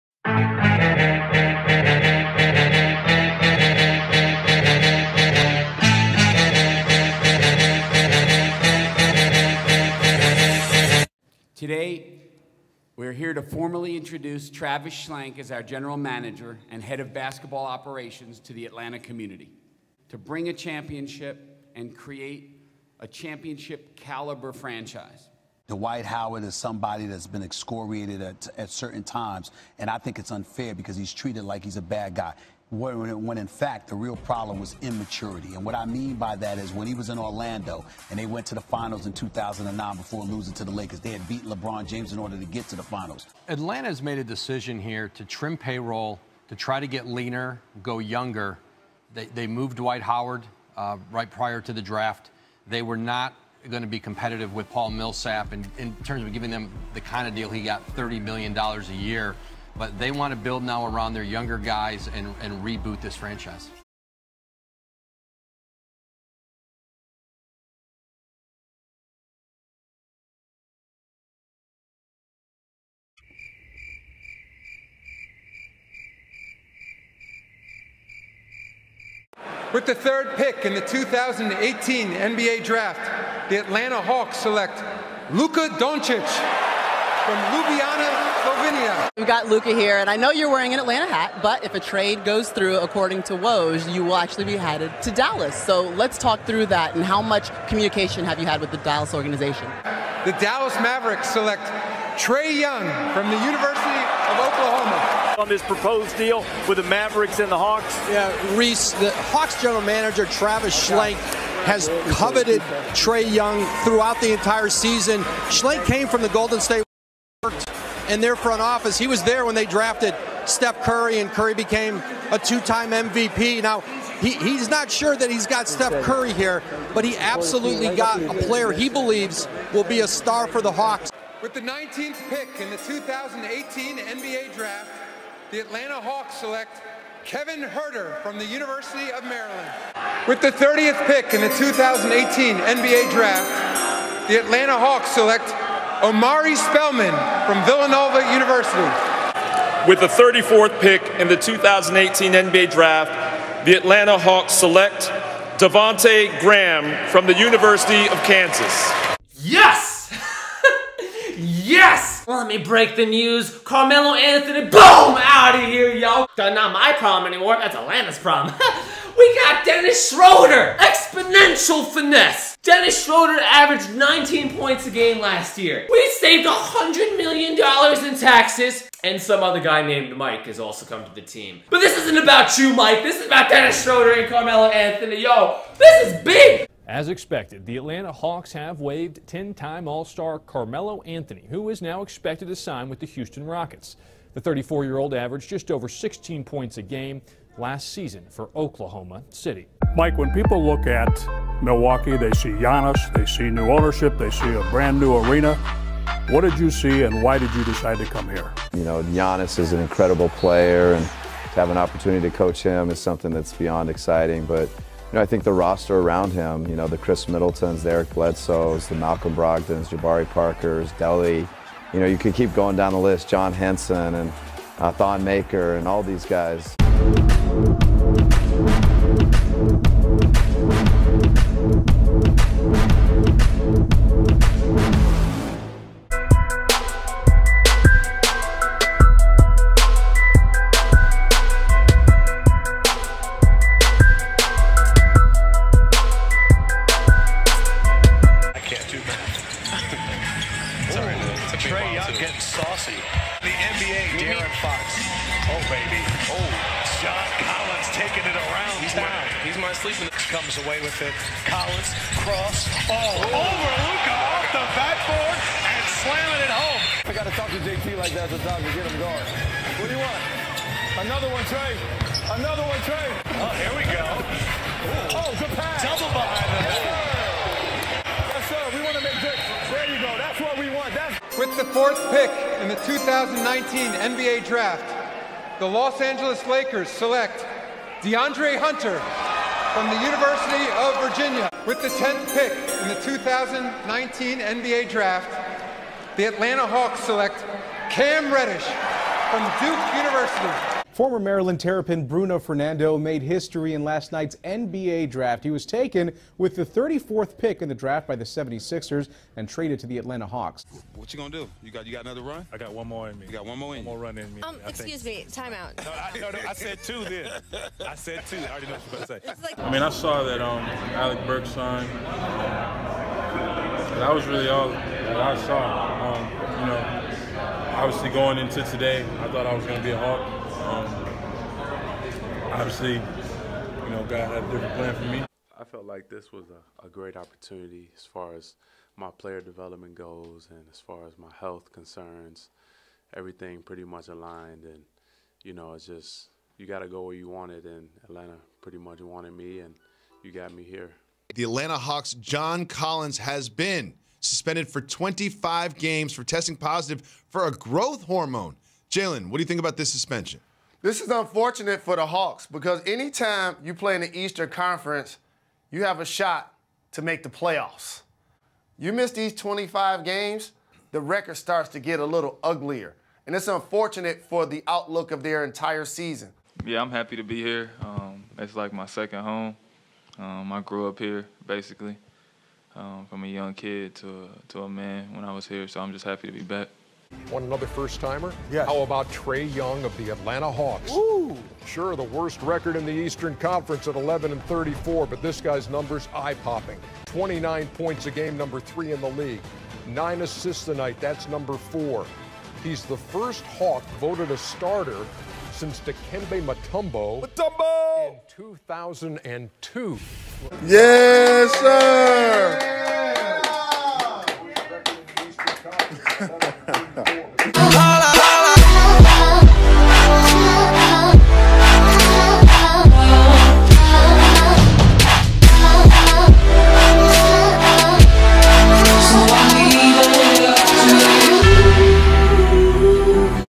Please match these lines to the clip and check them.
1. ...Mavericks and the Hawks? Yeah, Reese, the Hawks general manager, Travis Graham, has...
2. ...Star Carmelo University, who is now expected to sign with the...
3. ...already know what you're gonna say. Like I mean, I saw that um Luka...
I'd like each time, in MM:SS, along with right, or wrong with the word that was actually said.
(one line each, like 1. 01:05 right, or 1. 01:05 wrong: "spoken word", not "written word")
1. 01:46 wrong: "Schlenk", not "Graham"
2. 03:10 wrong: "Anthony", not "University"
3. 05:18 wrong: "Alec", not "Luka".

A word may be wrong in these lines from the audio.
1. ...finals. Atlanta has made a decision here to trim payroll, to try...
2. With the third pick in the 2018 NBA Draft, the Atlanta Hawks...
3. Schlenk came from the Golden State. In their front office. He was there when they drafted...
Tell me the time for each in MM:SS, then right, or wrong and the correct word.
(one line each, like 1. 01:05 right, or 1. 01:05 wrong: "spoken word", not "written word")
1. 00:42 right
2. 01:19 right
3. 01:55 right.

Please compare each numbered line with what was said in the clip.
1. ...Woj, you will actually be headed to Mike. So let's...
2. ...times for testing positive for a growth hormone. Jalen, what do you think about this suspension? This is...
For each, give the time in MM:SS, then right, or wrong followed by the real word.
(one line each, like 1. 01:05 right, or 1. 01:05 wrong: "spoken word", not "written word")
1. 01:33 wrong: "Dallas", not "Mike"
2. 05:55 wrong: "games", not "times".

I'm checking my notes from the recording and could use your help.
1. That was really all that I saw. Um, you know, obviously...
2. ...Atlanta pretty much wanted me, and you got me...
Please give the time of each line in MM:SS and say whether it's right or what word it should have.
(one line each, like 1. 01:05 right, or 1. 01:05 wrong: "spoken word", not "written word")
1. 05:23 right
2. 05:48 right.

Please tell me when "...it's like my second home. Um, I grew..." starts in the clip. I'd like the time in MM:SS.
06:18.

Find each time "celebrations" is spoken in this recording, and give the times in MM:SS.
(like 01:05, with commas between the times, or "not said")
not said.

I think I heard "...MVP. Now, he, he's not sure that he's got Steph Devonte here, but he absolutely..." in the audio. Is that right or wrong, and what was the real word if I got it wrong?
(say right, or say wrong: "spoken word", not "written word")
wrong: "Curry", not "Devonte".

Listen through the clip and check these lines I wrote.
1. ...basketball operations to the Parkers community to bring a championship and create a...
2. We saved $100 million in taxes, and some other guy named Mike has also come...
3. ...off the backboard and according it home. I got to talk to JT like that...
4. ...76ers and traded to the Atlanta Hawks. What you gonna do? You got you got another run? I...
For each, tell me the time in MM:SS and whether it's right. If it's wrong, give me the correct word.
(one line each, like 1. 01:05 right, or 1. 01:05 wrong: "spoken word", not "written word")
1. 00:17 wrong: "Atlanta", not "Parkers"
2. 02:55 right
3. 04:24 wrong: "slamming", not "according"
4. 05:08 right.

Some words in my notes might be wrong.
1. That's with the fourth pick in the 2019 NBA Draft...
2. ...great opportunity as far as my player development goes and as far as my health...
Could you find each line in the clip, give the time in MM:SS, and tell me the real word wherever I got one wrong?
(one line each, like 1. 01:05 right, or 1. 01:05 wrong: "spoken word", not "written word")
1. 04:40 right
2. 05:36 right.